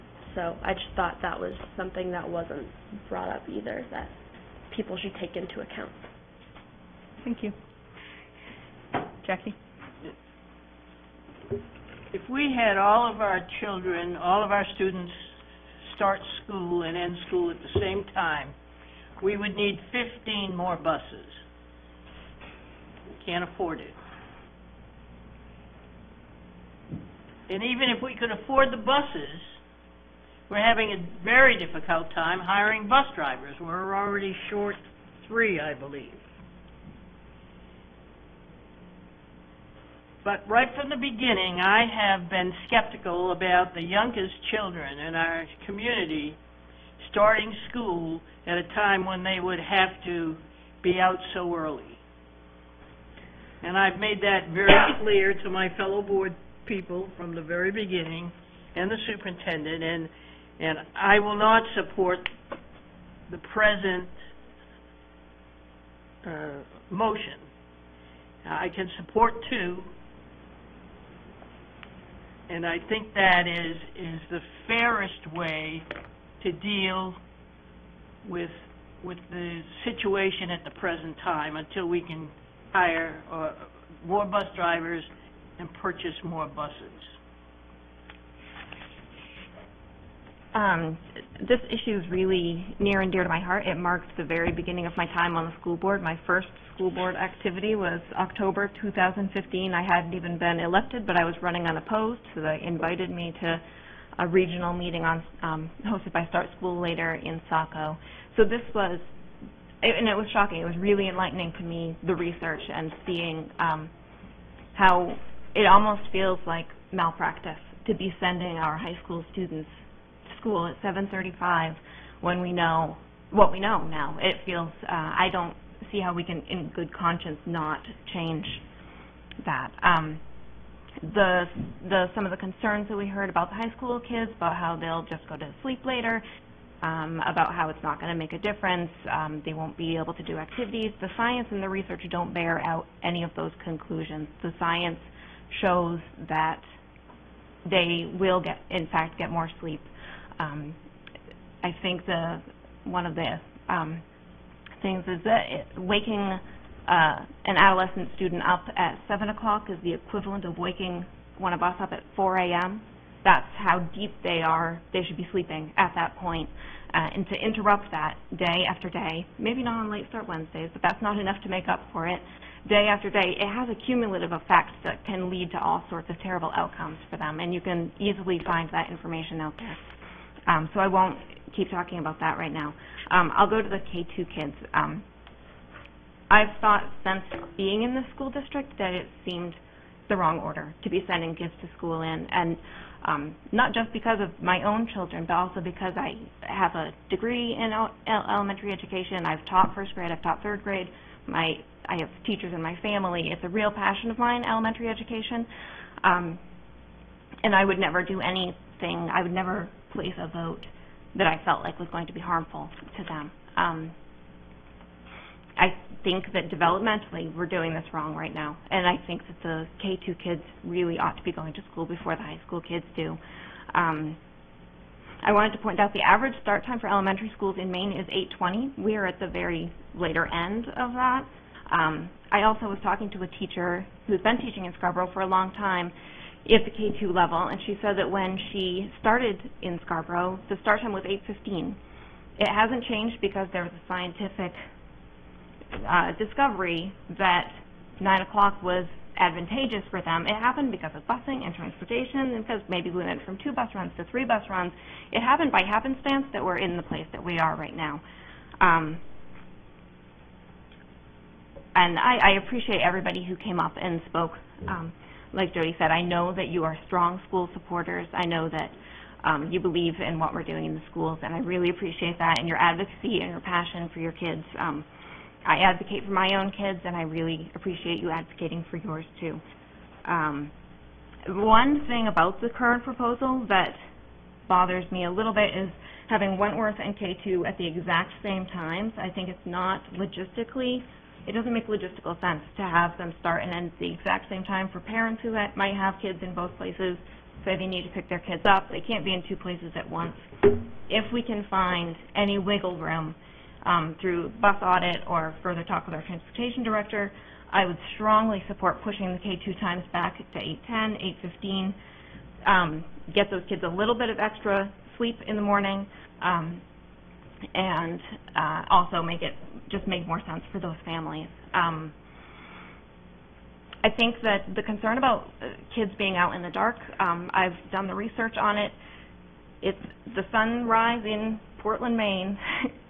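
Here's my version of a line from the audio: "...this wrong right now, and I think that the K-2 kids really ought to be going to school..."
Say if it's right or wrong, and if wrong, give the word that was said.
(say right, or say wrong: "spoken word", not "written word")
right.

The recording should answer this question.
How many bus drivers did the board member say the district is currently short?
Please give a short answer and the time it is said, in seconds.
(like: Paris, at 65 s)
3, at 34 s.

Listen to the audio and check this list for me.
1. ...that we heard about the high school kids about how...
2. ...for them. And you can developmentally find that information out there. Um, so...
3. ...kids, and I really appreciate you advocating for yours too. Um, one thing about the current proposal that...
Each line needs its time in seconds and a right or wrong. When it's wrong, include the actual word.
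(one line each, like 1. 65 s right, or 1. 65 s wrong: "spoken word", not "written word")
1. 132 s right
2. 177 s wrong: "easily", not "developmentally"
3. 276 s right.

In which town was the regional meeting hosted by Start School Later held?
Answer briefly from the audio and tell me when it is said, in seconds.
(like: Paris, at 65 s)
Saco, at 107 s.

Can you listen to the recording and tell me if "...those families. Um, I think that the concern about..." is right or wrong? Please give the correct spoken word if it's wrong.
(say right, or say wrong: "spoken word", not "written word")
right.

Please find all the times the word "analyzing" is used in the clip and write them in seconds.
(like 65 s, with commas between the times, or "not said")
not said.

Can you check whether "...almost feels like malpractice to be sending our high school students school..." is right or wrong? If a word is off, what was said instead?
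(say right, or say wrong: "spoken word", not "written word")
right.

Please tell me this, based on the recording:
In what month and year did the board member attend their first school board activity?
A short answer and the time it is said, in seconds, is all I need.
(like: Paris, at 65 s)
October 2015, at 98 s.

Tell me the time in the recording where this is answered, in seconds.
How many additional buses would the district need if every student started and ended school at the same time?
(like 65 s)
20 s.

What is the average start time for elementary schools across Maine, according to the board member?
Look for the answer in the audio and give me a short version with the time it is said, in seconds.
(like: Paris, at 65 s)
8:20, at 228 s.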